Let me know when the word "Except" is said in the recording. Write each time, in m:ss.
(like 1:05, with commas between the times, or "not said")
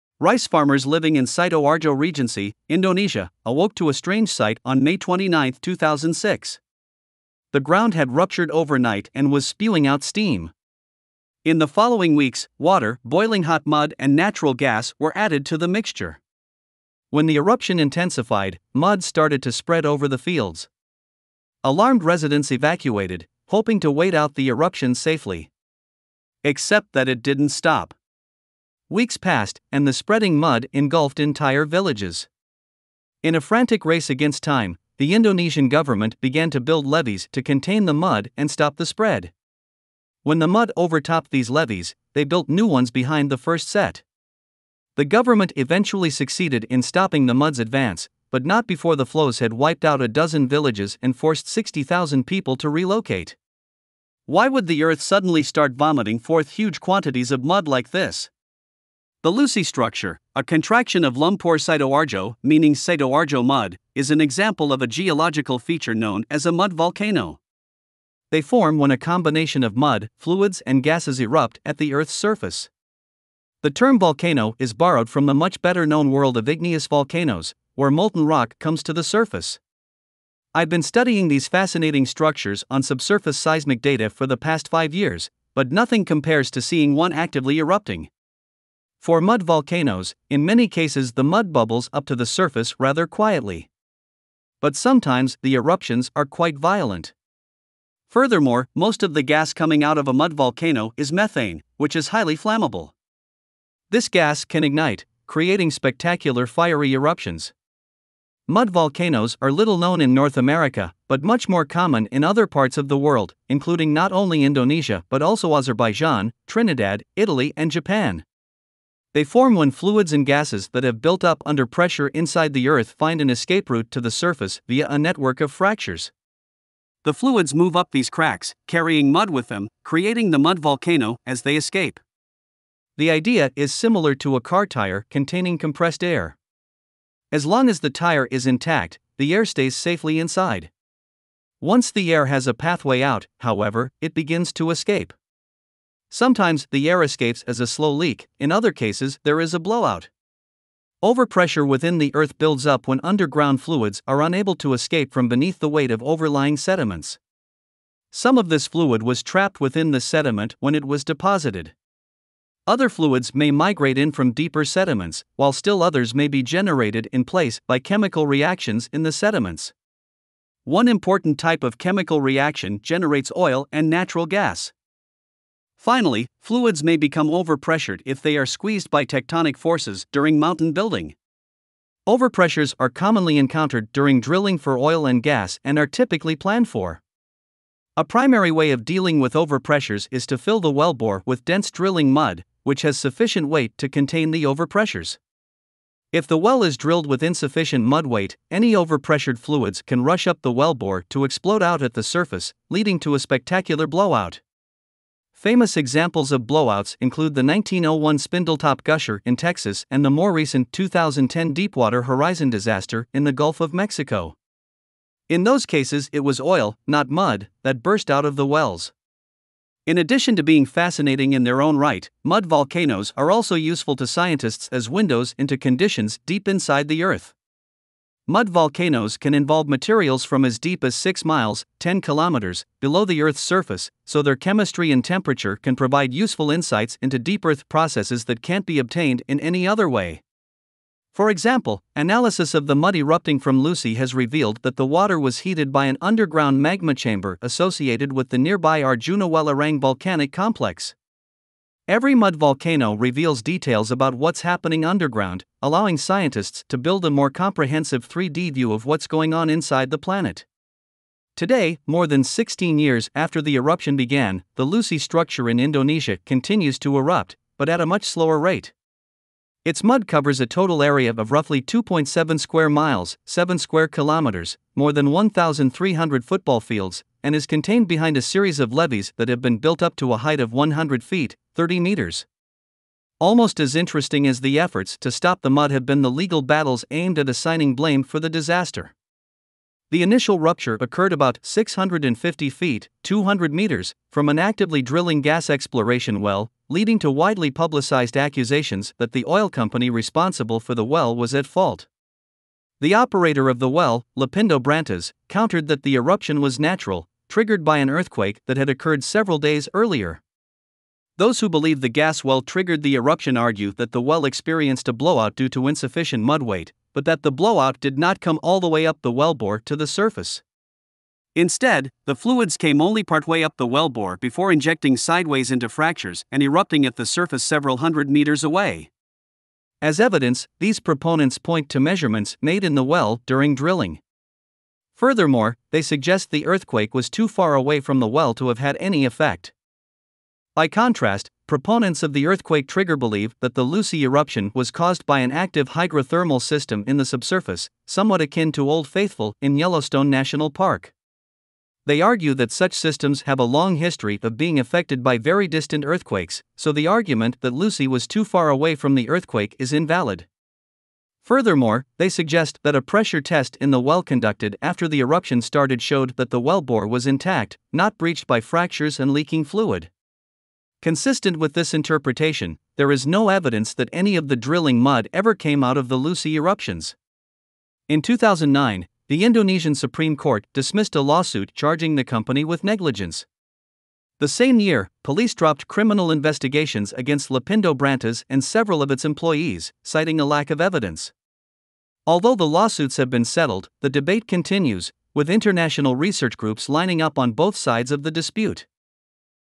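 0:26.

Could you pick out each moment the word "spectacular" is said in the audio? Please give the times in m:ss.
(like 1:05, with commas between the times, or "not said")
1:45, 3:23.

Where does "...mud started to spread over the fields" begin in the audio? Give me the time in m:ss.
0:18.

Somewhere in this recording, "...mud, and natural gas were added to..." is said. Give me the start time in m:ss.
0:13.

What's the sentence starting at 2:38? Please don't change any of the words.
Some of this fluid was trapped within the sediment when it was deposited.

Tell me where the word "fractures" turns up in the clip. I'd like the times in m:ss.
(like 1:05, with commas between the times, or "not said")
2:05, 5:25, 6:08.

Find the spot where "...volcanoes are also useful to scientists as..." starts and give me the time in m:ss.
3:42.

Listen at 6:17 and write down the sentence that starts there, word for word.
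In 2009, the Indonesian Supreme Court dismissed a lawsuit charging the company with negligence.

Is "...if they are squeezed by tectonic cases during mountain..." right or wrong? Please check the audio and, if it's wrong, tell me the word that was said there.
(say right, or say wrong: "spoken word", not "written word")
wrong: "forces", not "cases".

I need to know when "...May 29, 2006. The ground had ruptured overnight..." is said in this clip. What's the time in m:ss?
0:04.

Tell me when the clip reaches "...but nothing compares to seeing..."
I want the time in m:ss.
1:25.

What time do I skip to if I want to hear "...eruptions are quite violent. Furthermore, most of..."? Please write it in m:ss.
1:35.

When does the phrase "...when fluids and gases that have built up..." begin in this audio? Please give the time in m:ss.
1:59.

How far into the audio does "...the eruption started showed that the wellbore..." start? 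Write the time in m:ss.
6:04.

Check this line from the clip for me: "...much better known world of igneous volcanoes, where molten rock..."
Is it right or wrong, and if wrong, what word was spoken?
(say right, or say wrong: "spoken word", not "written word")
right.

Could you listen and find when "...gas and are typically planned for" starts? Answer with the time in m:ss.
3:05.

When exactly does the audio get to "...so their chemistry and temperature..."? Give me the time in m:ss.
3:54.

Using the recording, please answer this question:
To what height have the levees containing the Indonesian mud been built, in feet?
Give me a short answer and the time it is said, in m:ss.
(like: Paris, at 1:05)
100 feet, at 4:40.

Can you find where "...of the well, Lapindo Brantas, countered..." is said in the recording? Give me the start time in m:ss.
5:03.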